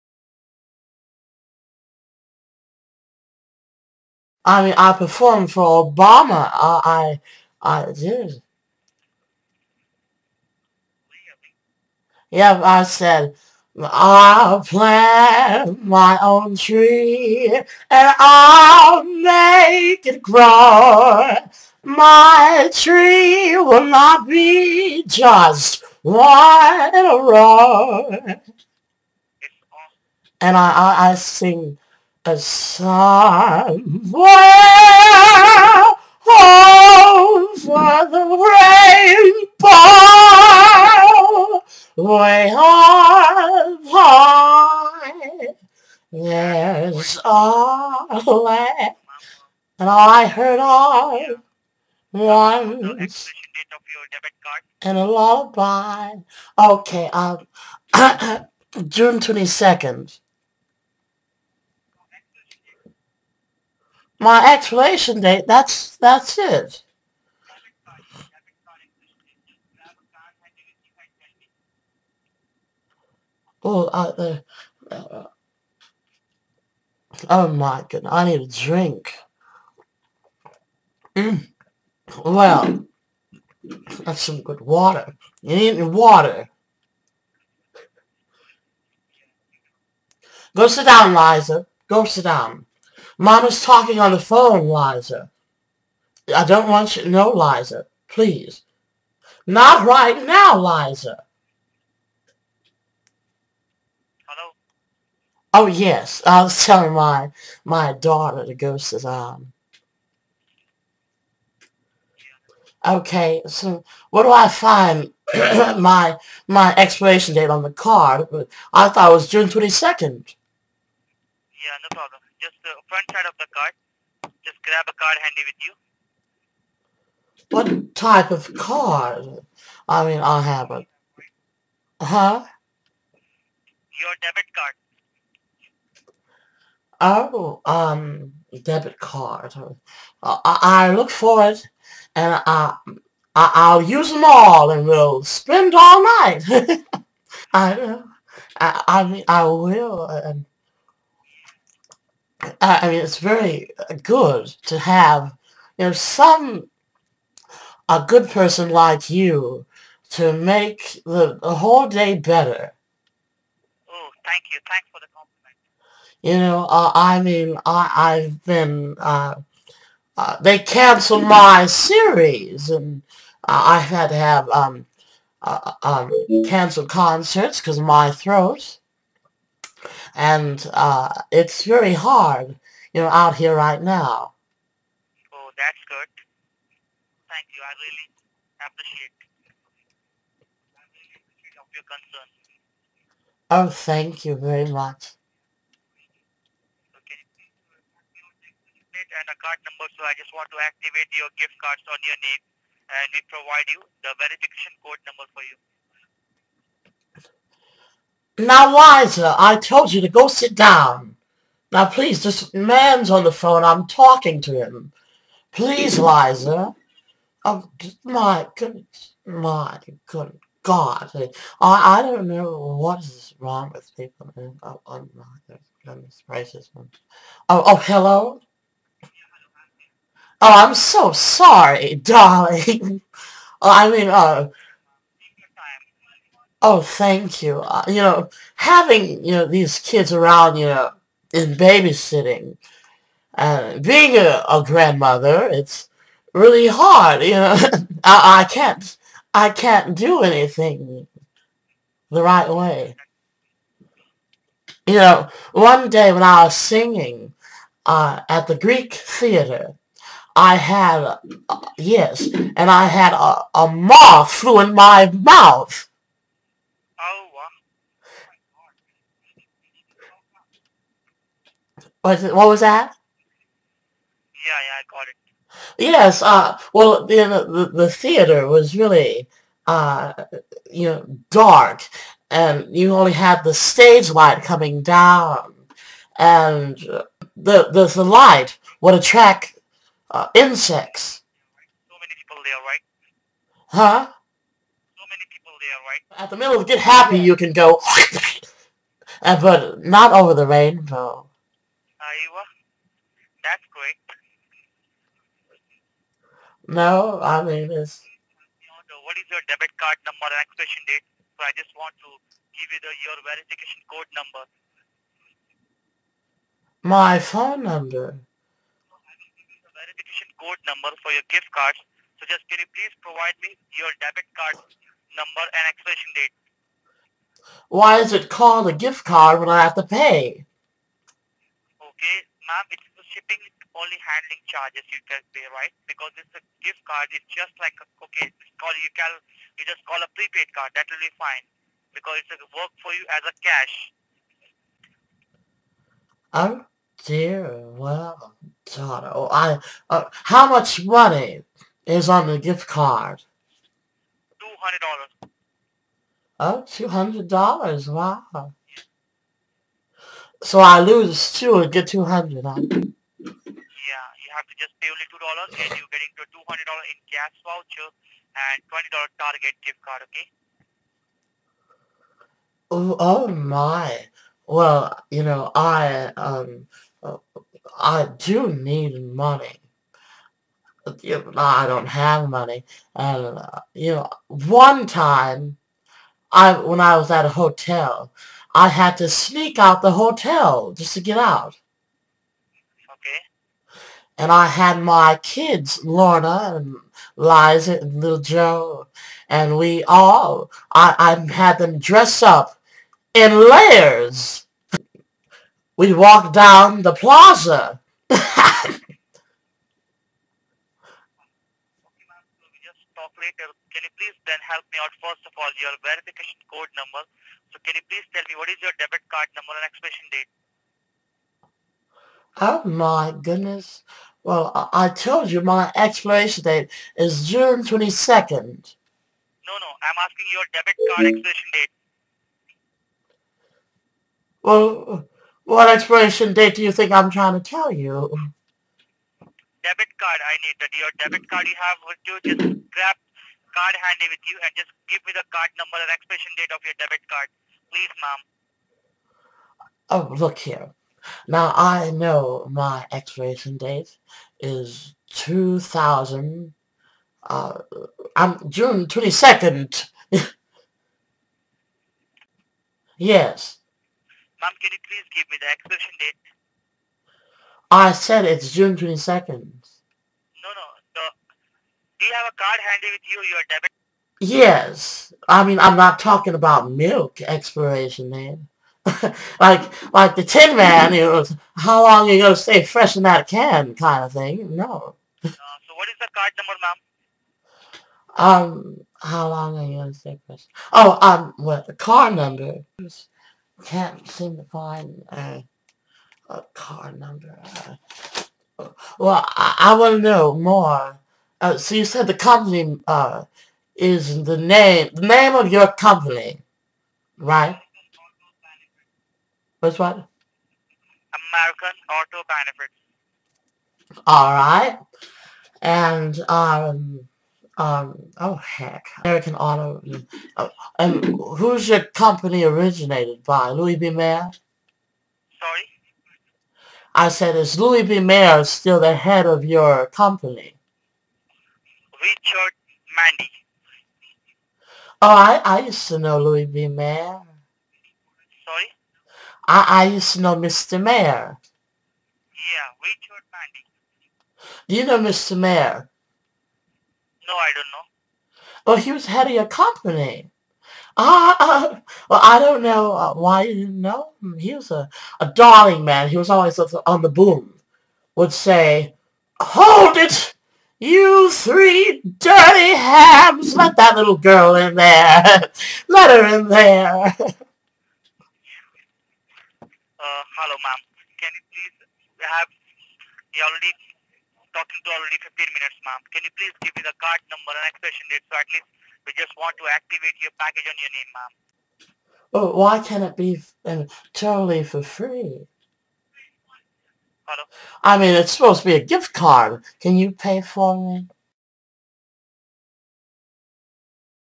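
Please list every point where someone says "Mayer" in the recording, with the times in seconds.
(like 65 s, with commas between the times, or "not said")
523 s, 527 s, 536 s, 540 s, 545 s.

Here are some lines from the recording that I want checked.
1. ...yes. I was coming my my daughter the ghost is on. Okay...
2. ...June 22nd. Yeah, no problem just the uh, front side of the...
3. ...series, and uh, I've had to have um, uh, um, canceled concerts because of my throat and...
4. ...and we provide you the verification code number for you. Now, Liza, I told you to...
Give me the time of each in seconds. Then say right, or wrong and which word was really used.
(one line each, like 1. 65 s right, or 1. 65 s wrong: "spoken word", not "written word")
1. 105 s wrong: "telling", not "coming"
2. 119 s right
3. 171 s right
4. 202 s right.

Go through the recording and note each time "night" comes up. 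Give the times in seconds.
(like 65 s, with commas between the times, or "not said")
146 s.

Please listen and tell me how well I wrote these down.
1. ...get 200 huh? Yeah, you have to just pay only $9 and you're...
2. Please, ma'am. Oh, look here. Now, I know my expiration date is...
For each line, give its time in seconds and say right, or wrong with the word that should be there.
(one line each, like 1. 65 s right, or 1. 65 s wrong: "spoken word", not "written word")
1. 361 s wrong: "2", not "9"
2. 447 s right.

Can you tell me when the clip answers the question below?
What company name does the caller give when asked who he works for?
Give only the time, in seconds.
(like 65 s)
511 s.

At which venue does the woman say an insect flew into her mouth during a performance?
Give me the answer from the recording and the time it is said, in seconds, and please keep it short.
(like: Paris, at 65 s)
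the Greek Theater, at 258 s.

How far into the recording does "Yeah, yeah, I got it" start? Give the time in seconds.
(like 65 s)
274 s.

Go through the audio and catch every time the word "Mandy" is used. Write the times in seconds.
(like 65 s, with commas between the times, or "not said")
532 s, 543 s.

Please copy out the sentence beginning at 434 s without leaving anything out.
Well, what expiration date do you think I'm trying to tell you?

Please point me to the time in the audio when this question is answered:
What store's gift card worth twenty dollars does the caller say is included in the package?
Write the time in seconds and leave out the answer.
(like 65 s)
369 s.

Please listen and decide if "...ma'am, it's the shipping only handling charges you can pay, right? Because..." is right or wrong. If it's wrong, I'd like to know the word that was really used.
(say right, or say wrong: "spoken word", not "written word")
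right.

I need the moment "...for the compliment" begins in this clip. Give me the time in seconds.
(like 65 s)
164 s.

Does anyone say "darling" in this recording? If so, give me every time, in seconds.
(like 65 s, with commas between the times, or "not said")
231 s, 555 s.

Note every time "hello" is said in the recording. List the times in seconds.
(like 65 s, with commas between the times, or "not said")
104 s, 227 s, 569 s.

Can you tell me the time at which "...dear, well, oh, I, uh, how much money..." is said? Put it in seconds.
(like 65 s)
347 s.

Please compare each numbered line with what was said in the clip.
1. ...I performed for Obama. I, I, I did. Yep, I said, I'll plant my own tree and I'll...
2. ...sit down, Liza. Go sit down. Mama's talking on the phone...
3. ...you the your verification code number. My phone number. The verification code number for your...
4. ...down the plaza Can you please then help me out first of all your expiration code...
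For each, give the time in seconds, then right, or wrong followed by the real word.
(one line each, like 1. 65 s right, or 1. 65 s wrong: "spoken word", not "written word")
1. 4 s right
2. 90 s right
3. 312 s right
4. 406 s wrong: "verification", not "expiration".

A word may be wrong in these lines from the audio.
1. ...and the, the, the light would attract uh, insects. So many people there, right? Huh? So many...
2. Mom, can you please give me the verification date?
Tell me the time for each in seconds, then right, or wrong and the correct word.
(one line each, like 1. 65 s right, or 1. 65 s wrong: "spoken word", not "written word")
1. 286 s right
2. 464 s wrong: "expiration", not "verification".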